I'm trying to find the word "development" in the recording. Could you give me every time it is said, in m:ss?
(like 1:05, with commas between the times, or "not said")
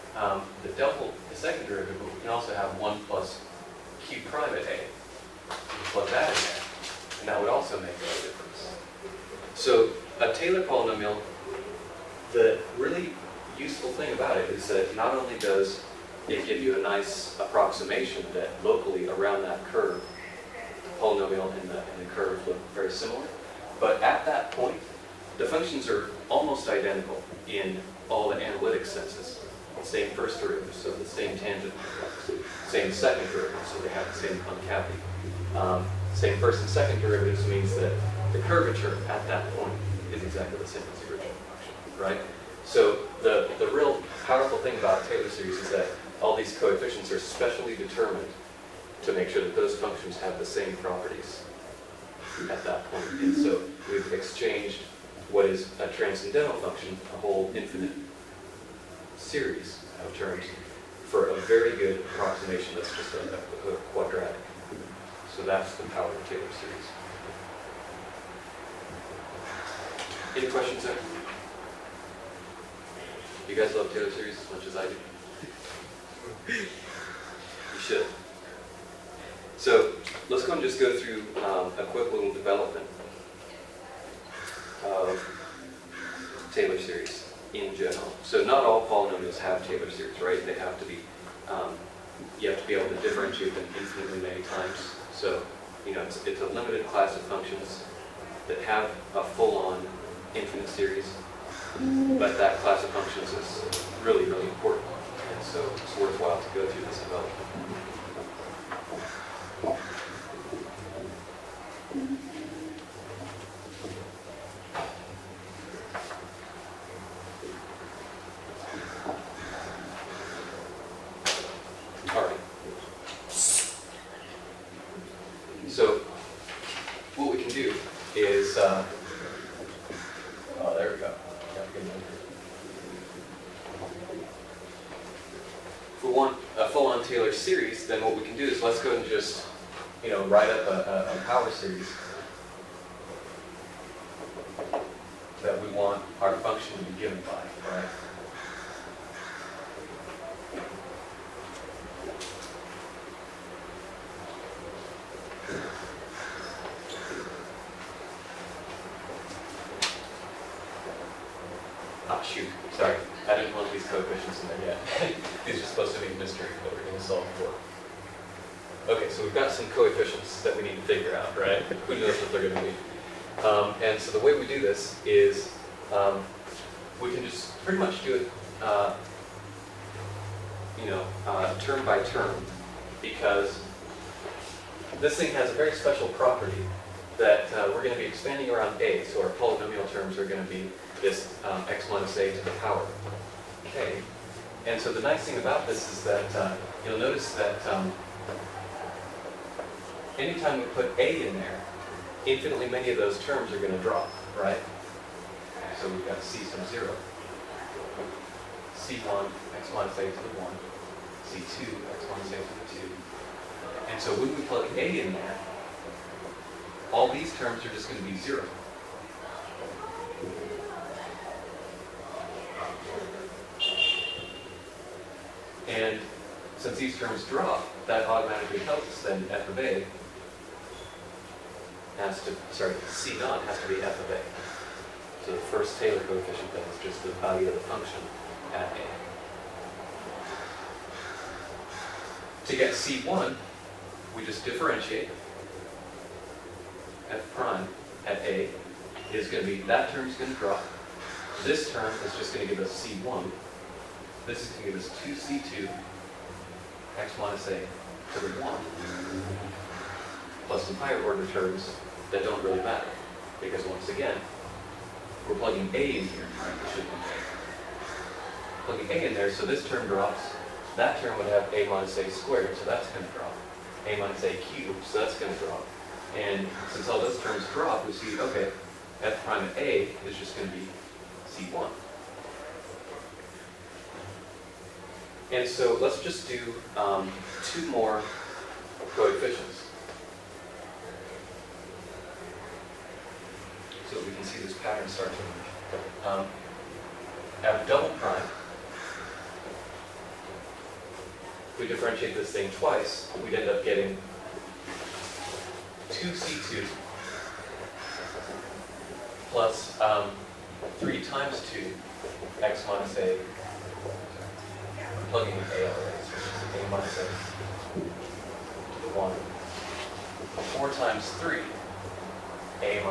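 1:22, 1:47.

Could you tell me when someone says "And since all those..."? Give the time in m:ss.
4:36.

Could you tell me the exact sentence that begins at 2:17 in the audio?
series, then what we can do is let's go and just you know write up a, a power series.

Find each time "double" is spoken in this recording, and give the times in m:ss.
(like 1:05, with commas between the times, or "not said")
0:00, 4:57.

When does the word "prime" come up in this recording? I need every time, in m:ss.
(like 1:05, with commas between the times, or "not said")
0:04, 4:07, 4:39, 4:57.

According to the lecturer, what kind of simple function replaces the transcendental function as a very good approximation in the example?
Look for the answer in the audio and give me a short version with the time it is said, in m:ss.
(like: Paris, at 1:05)
A quadratic, at 1:03.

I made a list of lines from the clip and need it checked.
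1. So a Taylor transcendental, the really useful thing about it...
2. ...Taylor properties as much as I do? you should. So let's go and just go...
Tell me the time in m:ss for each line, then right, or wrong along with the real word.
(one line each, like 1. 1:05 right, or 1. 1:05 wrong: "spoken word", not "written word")
1. 0:09 wrong: "polynomial", not "transcendental"
2. 1:13 wrong: "series", not "properties".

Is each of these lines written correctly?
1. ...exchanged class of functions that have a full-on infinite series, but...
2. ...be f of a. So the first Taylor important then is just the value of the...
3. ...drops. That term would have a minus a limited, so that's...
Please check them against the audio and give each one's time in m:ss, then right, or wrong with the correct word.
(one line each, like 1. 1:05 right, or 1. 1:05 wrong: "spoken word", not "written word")
1. 1:36 wrong: "limited", not "exchanged"
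2. 3:53 wrong: "coefficient", not "important"
3. 4:29 wrong: "squared", not "limited".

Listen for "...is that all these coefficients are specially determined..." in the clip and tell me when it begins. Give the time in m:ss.
0:45.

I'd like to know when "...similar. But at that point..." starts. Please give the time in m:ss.
0:22.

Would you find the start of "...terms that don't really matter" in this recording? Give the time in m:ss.
4:21.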